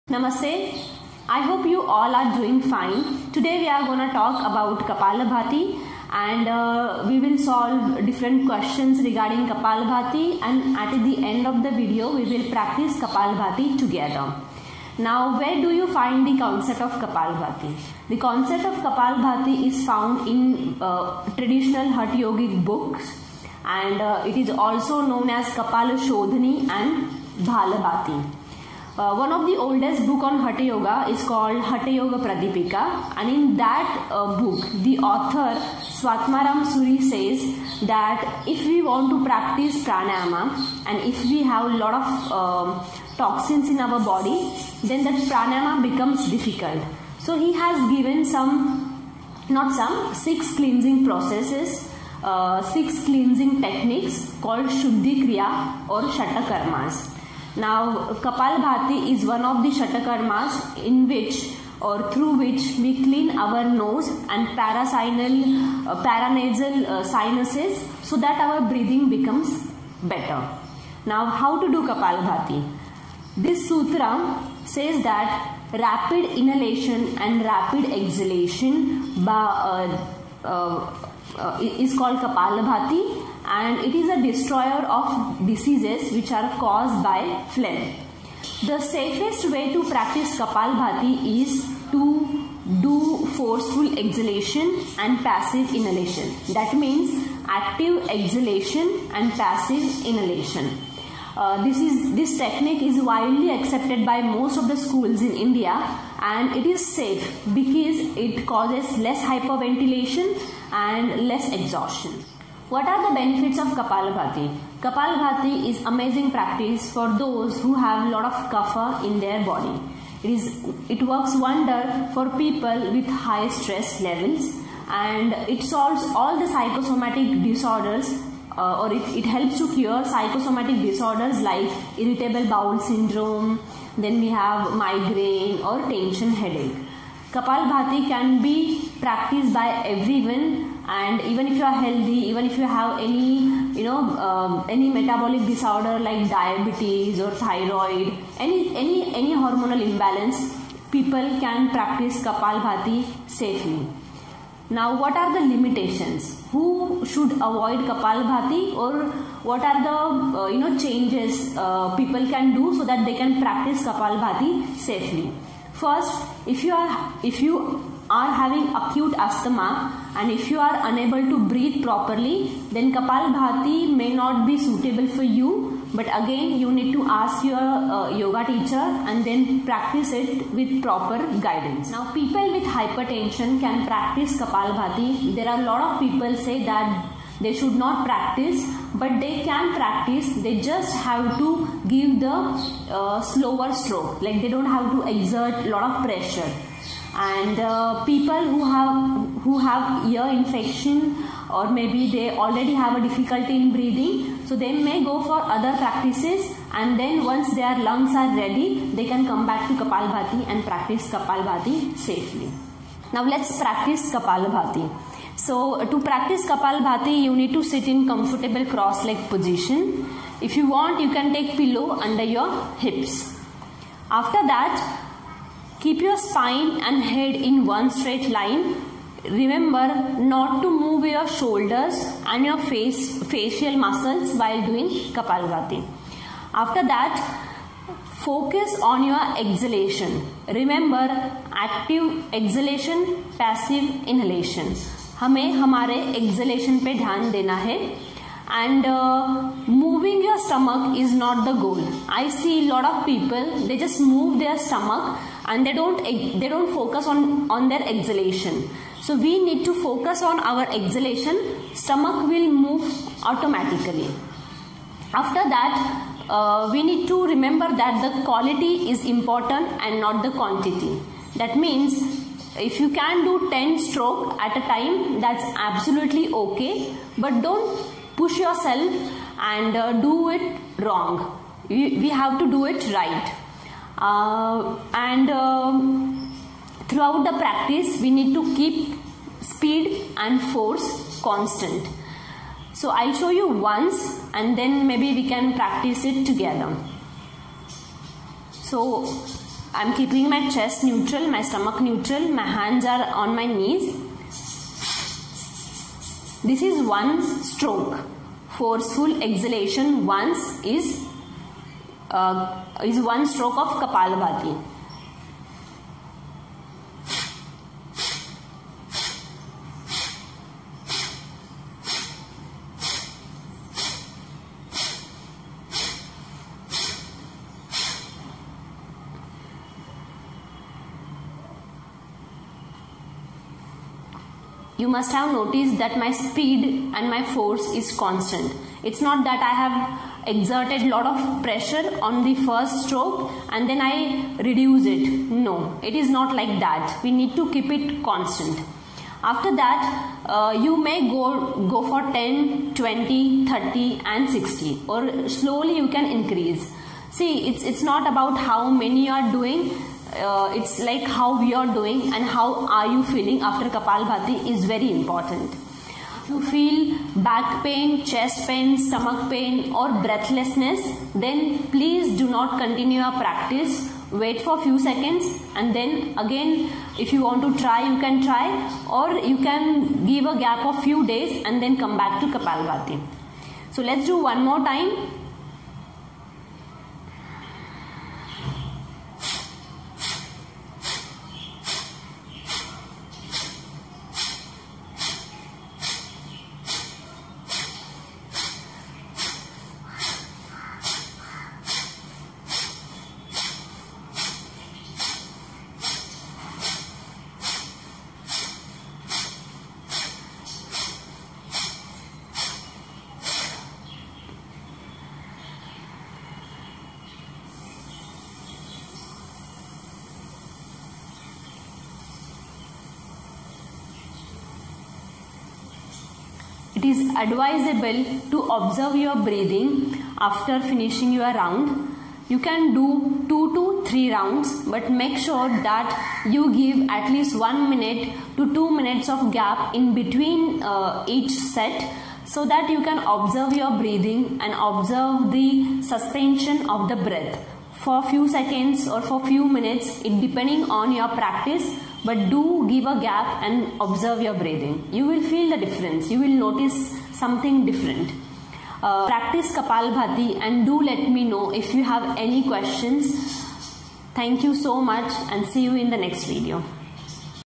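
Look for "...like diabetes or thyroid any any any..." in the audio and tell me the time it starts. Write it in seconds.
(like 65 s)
145 s.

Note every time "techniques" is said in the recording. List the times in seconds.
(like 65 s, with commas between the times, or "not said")
53 s, 102 s.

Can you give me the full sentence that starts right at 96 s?
That means active exhalation and passive inhalation.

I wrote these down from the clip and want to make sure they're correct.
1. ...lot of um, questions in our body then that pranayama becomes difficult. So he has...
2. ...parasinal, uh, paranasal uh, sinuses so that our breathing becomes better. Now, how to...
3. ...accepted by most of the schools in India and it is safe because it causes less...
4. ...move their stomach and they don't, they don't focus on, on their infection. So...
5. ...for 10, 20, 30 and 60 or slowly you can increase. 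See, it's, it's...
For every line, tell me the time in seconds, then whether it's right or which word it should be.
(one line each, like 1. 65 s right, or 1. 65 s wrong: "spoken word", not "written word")
1. 41 s wrong: "toxins", not "questions"
2. 64 s right
3. 103 s right
4. 254 s wrong: "exhalation", not "infection"
5. 351 s right.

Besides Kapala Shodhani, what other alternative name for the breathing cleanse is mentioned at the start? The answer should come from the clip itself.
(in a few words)
Bhalabhati.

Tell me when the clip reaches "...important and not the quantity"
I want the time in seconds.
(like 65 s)
269 s.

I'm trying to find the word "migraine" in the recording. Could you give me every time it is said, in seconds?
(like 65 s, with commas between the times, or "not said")
134 s.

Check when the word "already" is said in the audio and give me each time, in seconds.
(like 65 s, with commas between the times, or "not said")
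202 s.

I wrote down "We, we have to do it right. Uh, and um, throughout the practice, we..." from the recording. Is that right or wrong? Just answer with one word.
right.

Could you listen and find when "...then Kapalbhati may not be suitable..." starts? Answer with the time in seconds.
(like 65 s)
172 s.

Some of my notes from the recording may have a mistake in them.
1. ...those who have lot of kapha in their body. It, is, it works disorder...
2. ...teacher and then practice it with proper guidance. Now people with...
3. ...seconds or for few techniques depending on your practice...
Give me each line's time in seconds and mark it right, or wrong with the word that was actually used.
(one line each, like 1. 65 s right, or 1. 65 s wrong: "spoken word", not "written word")
1. 117 s wrong: "wonder", not "disorder"
2. 178 s right
3. 448 s wrong: "minutes", not "techniques".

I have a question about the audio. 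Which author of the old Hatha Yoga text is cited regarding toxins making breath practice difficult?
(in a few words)
Swatmaram Suri.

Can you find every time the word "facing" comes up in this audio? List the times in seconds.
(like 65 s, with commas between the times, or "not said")
not said.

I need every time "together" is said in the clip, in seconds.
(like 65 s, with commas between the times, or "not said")
13 s, 296 s.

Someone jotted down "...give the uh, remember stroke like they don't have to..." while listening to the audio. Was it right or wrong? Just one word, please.
wrong.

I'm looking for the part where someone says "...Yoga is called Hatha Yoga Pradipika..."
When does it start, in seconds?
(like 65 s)
30 s.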